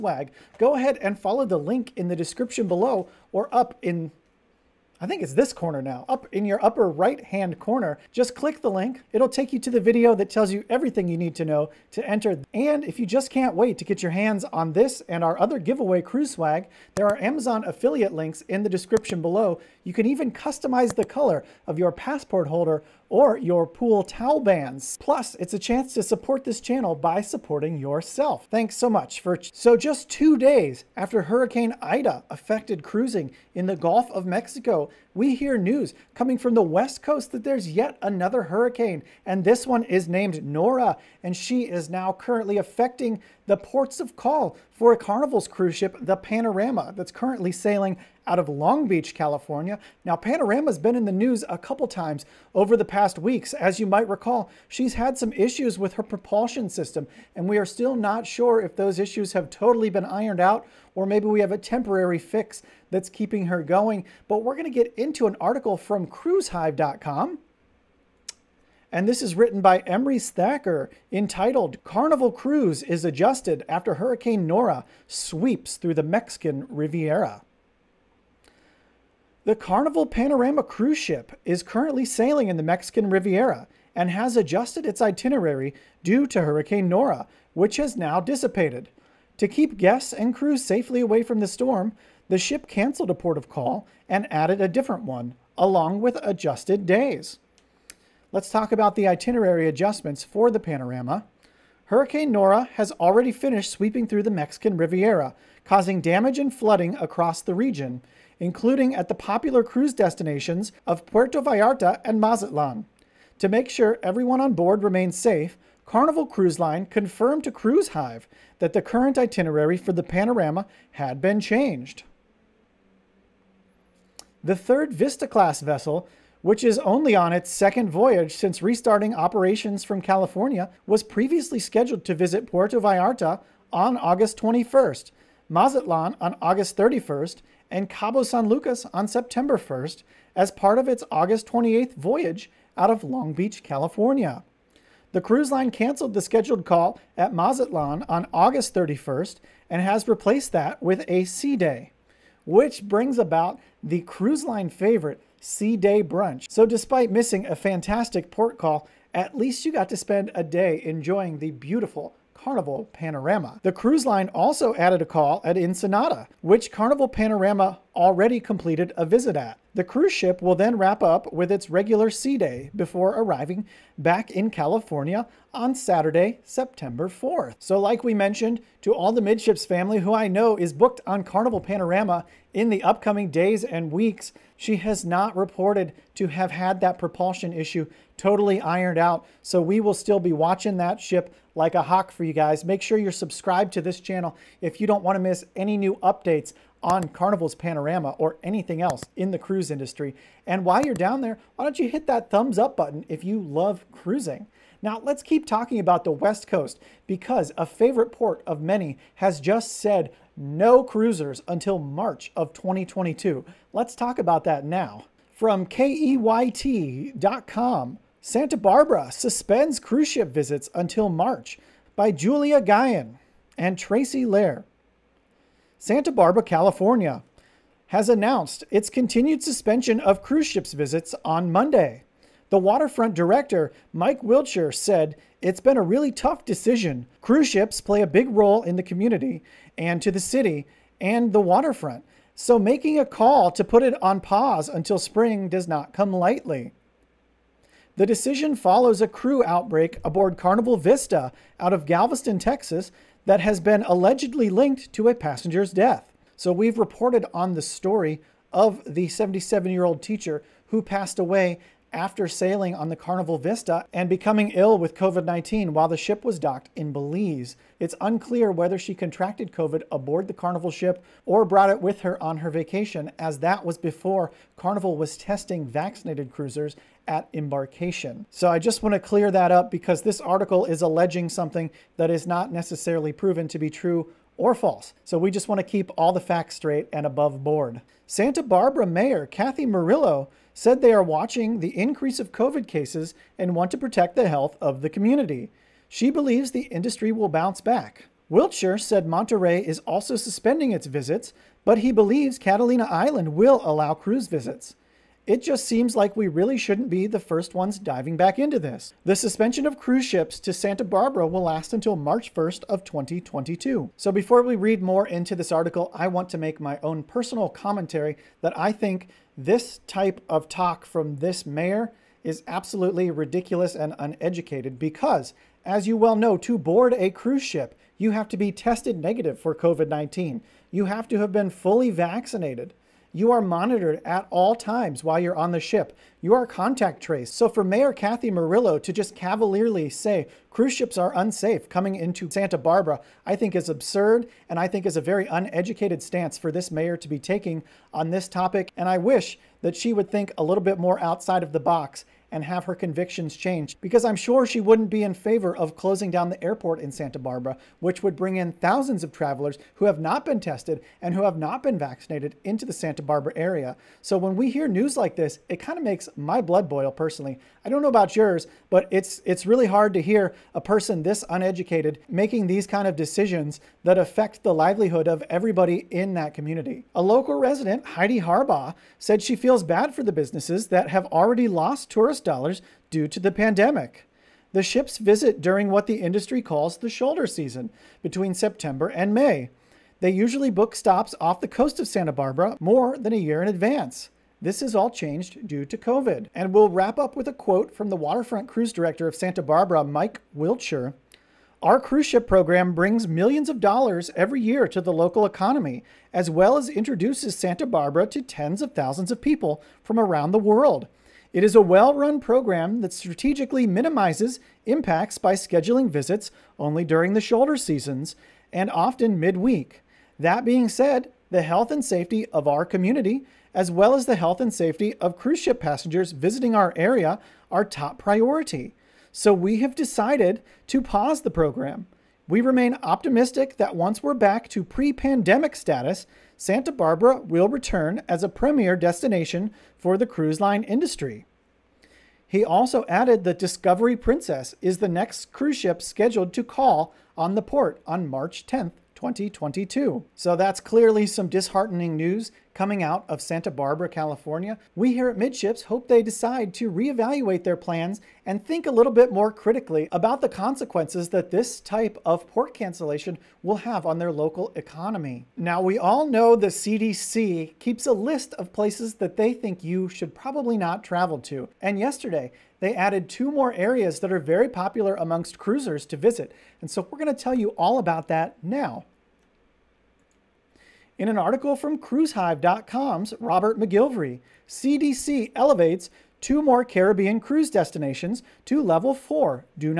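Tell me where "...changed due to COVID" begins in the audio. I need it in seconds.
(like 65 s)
394 s.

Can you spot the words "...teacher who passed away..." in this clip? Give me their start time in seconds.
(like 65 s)
260 s.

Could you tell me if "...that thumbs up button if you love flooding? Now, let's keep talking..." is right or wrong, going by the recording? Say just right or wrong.
wrong.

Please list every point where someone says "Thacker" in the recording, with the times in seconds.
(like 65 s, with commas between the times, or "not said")
70 s.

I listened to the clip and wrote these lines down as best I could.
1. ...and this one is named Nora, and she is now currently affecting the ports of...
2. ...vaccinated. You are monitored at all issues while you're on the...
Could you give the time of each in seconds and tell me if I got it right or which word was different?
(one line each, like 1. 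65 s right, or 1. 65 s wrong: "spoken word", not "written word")
1. 39 s right
2. 331 s wrong: "times", not "issues".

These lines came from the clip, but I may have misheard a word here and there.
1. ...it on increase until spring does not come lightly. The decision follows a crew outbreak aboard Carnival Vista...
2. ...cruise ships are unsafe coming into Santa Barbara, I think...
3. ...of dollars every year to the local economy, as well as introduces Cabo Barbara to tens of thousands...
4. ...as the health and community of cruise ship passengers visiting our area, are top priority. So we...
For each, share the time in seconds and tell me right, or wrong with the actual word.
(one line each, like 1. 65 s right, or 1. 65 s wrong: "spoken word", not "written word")
1. 243 s wrong: "pause", not "increase"
2. 340 s right
3. 403 s wrong: "Santa", not "Cabo"
4. 423 s wrong: "safety", not "community".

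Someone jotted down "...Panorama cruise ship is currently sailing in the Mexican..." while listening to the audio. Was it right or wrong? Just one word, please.
right.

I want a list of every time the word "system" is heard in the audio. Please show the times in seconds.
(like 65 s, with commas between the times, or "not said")
56 s.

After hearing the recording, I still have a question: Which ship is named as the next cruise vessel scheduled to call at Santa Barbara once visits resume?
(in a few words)
Discovery Princess.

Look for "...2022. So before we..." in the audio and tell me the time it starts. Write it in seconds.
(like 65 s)
312 s.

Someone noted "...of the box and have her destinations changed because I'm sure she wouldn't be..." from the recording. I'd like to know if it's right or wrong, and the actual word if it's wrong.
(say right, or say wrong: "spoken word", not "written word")
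wrong: "convictions", not "destinations".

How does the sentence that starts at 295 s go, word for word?
She believes the industry will bounce back.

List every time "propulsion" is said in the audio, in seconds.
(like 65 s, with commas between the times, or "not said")
56 s, 186 s.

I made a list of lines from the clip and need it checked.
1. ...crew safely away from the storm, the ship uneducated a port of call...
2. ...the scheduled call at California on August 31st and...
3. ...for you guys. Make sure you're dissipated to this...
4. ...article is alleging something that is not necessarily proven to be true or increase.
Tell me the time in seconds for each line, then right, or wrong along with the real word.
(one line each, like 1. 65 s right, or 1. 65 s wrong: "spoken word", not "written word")
1. 90 s wrong: "canceled", not "uneducated"
2. 146 s wrong: "Mazatlan", not "California"
3. 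192 s wrong: "subscribed", not "dissipated"
4. 280 s wrong: "false", not "increase".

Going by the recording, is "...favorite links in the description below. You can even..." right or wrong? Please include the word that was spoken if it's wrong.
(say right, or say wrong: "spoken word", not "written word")
wrong: "affiliate", not "favorite".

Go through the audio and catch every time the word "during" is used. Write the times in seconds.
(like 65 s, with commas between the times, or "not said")
385 s, 416 s.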